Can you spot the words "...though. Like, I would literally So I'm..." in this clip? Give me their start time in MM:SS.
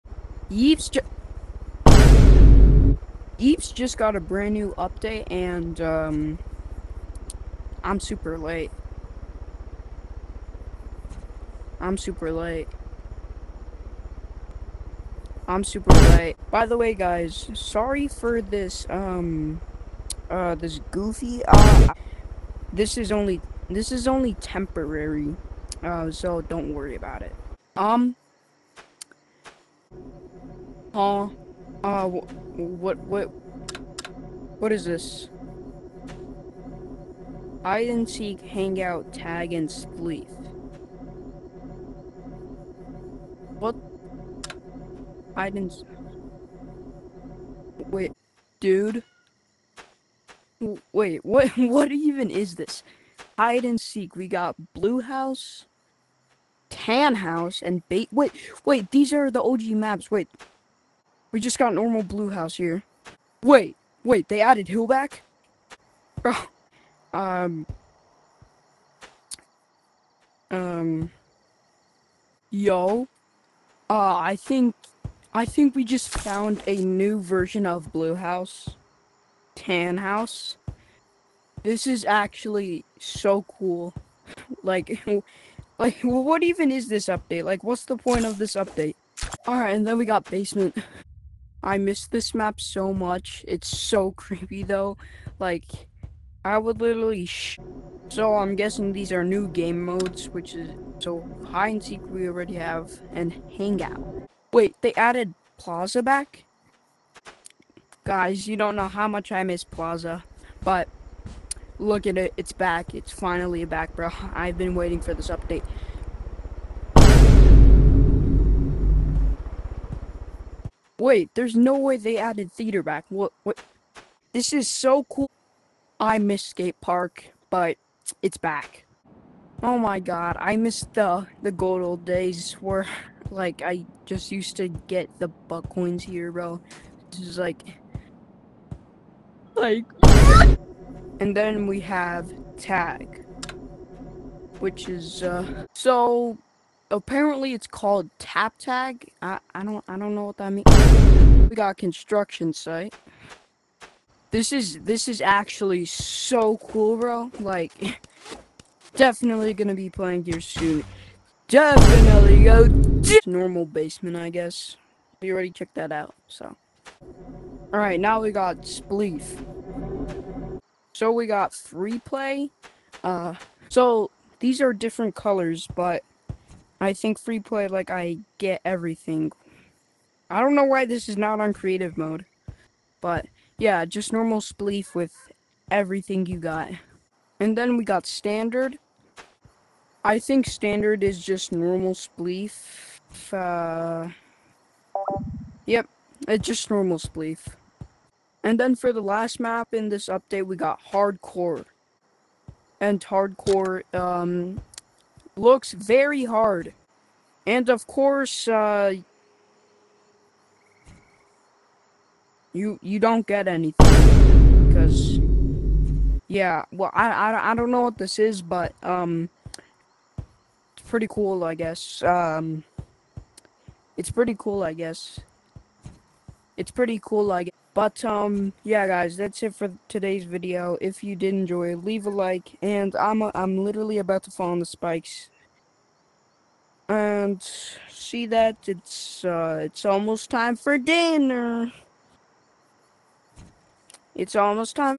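01:34.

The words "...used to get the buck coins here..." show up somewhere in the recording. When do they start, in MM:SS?
02:14.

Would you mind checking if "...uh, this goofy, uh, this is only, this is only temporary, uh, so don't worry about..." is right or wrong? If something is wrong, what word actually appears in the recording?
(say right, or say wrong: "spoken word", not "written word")
right.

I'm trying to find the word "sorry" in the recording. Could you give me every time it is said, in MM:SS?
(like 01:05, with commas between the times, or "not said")
00:17.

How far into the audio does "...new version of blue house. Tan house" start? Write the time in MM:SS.
01:16.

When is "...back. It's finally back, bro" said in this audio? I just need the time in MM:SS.
01:52.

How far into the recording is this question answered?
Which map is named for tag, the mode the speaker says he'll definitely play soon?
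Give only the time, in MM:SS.
02:31.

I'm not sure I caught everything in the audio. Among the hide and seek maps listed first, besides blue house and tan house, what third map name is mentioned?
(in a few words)
Bait.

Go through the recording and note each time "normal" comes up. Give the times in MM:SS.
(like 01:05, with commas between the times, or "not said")
01:01, 02:43, 03:04, 03:11, 03:16.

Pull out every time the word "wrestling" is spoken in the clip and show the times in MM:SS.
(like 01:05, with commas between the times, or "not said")
not said.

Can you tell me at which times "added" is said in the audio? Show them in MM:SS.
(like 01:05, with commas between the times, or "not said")
01:04, 01:44, 02:02.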